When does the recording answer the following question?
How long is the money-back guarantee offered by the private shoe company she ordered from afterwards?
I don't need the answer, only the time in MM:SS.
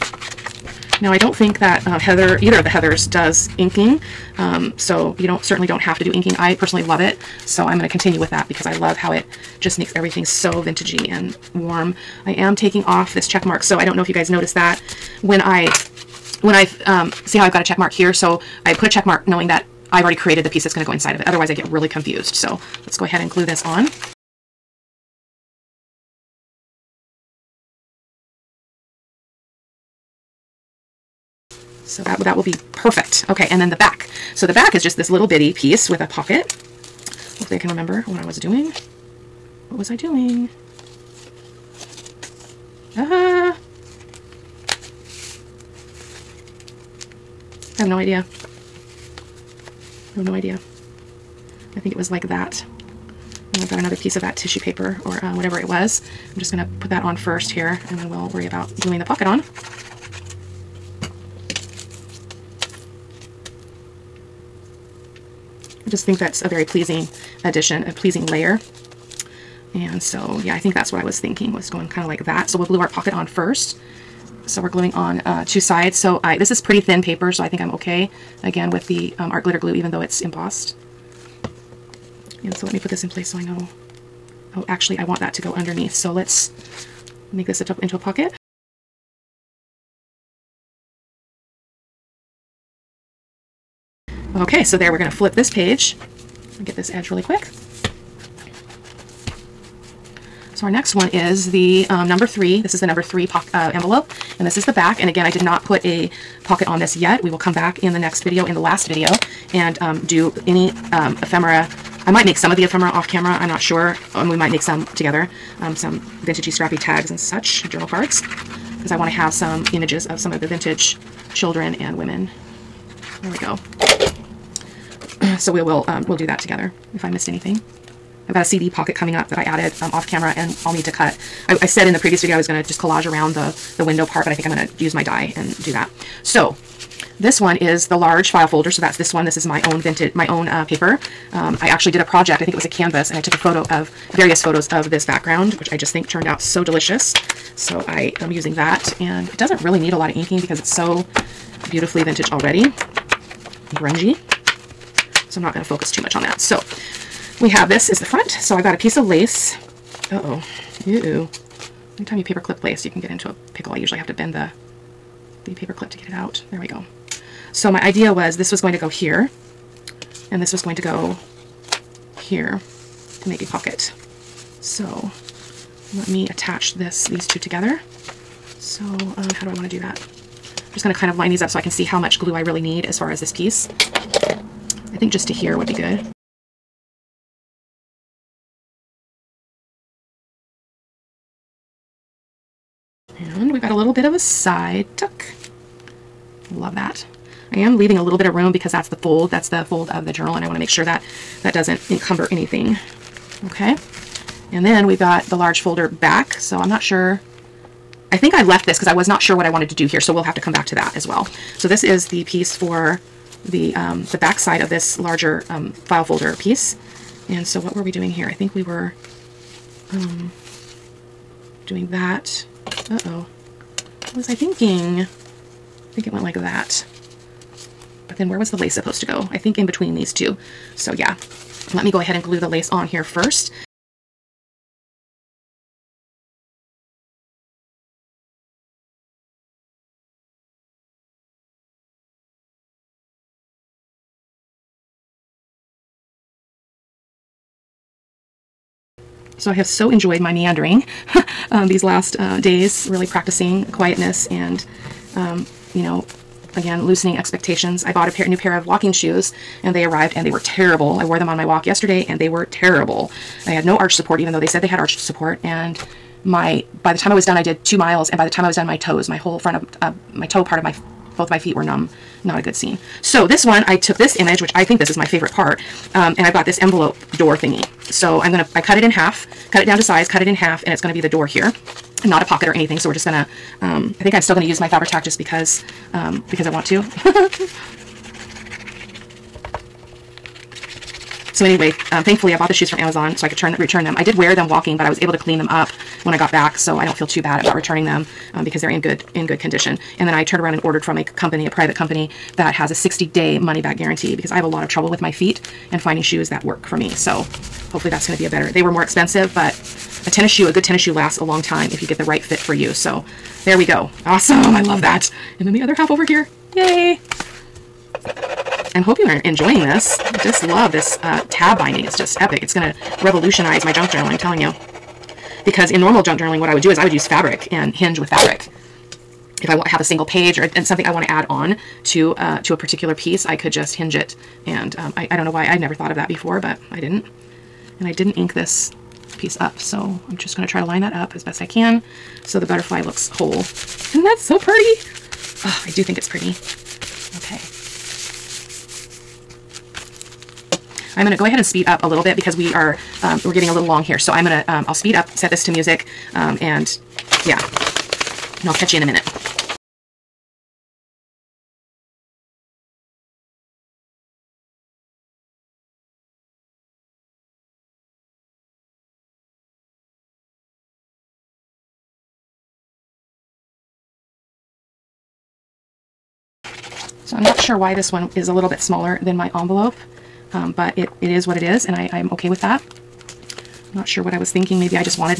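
05:02.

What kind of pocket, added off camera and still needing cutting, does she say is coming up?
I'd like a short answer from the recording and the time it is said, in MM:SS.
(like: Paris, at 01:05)
CD pocket, at 02:08.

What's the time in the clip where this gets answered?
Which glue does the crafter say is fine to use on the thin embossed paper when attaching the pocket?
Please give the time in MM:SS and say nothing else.
01:19.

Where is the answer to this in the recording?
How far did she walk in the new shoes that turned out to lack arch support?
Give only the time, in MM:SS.
04:27.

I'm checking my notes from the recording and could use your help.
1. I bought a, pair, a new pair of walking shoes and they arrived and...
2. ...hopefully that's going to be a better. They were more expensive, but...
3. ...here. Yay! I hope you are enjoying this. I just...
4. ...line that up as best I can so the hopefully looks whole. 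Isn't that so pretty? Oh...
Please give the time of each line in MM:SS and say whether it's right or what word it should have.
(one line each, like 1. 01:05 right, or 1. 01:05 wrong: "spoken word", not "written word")
1. 04:17 right
2. 05:07 right
3. 05:16 right
4. 05:40 wrong: "butterfly", not "hopefully".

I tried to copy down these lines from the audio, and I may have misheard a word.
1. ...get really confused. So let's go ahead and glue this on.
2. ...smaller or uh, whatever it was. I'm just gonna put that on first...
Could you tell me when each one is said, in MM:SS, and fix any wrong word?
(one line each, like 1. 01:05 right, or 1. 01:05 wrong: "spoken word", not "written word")
1. 00:21 right
2. 00:54 wrong: "paper", not "smaller".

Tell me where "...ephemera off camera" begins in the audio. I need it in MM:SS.
01:52.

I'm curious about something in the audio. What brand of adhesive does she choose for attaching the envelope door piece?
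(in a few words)
Fabri-Tac.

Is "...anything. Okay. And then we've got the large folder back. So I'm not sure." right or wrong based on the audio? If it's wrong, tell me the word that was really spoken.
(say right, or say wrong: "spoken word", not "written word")
right.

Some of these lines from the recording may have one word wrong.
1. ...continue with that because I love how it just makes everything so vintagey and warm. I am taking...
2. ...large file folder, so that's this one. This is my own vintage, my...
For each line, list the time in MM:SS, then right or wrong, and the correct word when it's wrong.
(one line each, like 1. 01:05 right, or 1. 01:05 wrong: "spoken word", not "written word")
1. 00:07 right
2. 02:17 right.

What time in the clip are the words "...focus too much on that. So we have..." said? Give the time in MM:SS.
02:35.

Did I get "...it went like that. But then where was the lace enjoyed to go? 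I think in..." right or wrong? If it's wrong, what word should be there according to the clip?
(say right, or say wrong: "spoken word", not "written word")
wrong: "supposed", not "enjoyed".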